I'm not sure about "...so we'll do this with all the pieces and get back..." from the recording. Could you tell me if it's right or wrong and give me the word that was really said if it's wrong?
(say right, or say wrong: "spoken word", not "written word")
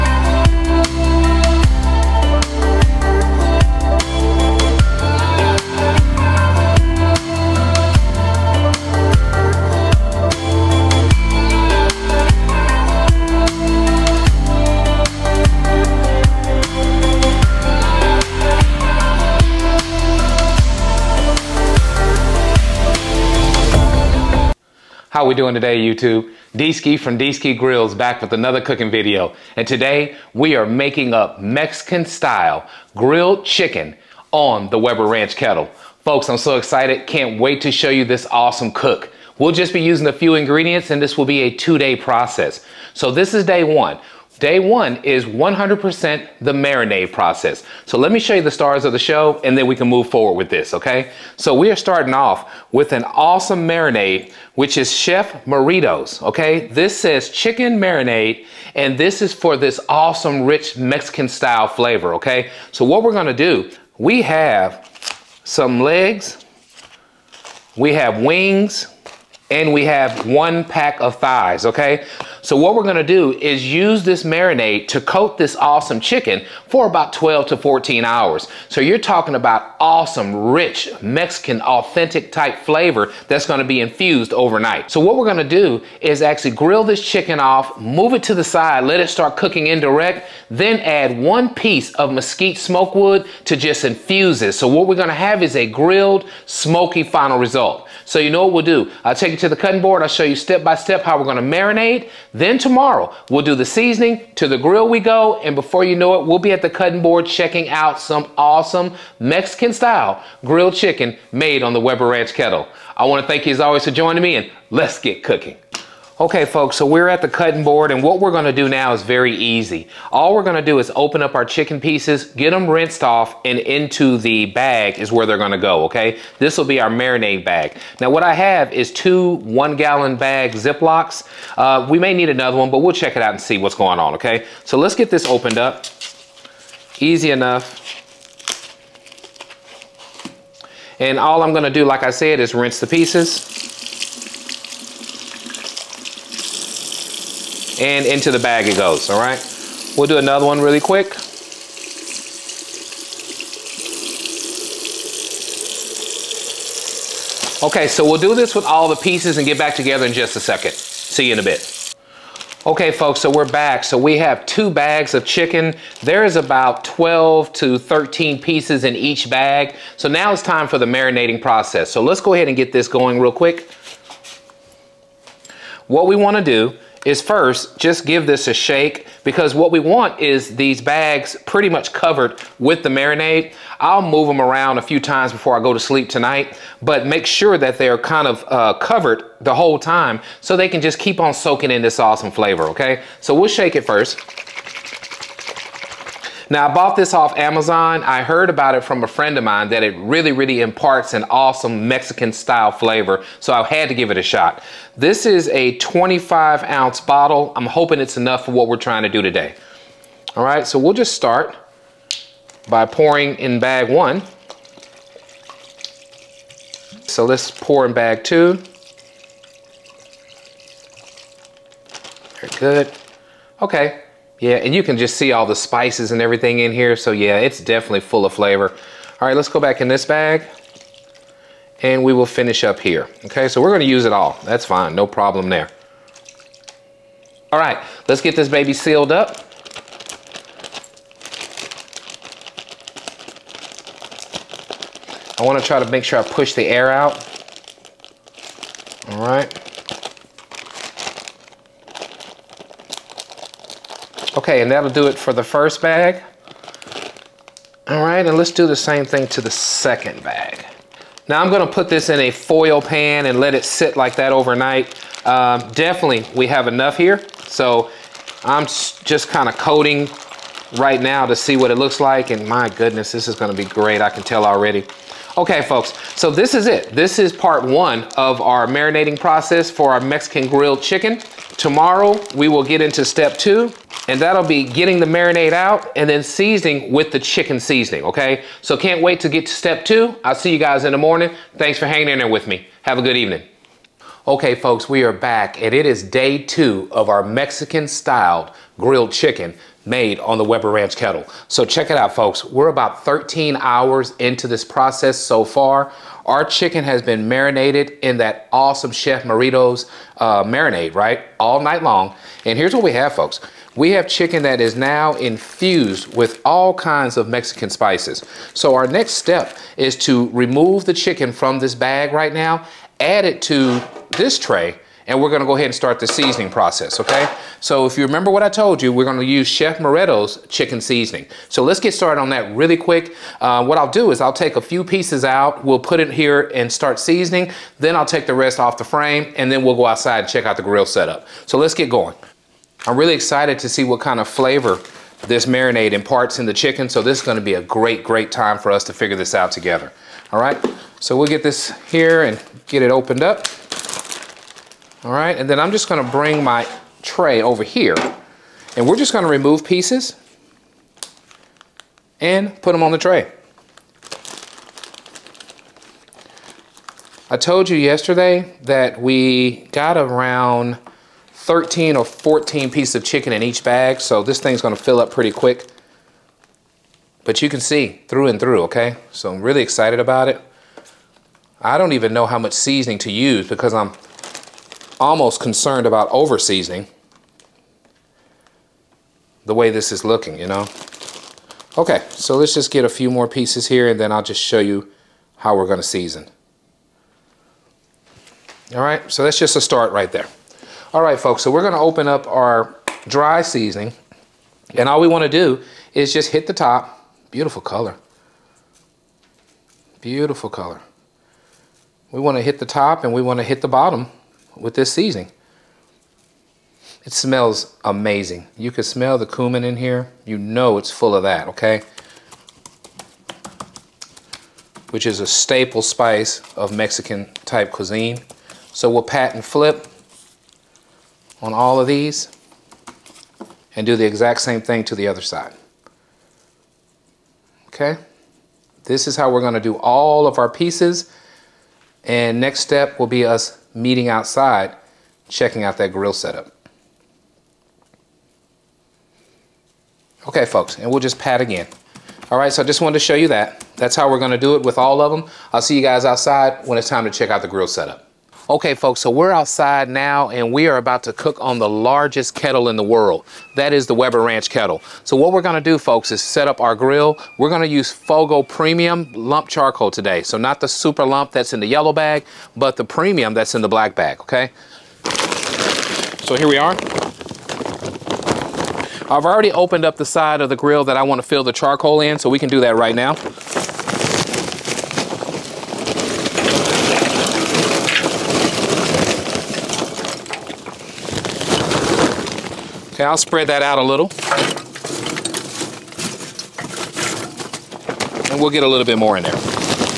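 right.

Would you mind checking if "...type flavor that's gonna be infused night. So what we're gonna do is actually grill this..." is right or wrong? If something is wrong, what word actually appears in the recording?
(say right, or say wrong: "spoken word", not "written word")
wrong: "overnight", not "night".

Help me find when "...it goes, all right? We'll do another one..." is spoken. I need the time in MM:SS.
02:28.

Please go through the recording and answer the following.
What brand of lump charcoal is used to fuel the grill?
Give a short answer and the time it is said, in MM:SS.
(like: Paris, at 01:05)
Fogo, at 07:47.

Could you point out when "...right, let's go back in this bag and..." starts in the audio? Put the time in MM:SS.
03:49.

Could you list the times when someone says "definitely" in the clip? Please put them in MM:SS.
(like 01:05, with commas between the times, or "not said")
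03:47, 04:25.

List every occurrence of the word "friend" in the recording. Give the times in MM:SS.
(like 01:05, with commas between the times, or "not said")
03:19.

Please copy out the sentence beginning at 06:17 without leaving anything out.
But you can see through and through, okay?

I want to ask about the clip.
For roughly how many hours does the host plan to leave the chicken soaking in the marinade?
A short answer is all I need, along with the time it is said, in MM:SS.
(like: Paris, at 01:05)
12 to 14 hours, at 01:17.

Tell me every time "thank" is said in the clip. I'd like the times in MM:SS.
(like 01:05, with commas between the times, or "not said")
01:53, 04:51.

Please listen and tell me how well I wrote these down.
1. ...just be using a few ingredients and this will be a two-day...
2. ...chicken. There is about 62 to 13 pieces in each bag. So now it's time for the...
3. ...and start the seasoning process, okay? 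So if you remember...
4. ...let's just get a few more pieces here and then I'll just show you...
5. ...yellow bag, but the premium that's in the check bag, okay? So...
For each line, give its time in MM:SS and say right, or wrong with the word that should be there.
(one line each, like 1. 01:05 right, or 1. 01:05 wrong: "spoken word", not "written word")
1. 00:39 right
2. 02:45 wrong: "12", not "62"
3. 05:25 right
4. 06:32 right
5. 07:51 wrong: "black", not "check".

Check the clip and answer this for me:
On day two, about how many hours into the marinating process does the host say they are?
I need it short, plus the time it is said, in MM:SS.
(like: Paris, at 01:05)
13, at 05:03.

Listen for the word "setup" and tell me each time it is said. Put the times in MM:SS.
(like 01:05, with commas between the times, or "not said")
05:40, 07:26, 07:37.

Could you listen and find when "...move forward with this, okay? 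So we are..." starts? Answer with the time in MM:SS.
00:49.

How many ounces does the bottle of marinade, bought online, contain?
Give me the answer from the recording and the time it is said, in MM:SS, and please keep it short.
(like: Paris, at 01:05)
25, at 03:25.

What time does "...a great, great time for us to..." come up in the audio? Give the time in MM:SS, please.
05:47.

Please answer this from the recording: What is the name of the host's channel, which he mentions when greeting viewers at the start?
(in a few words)
Dski Grillz.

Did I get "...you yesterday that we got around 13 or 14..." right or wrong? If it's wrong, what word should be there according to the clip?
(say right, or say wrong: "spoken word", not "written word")
right.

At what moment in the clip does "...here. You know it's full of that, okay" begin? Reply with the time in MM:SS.
06:59.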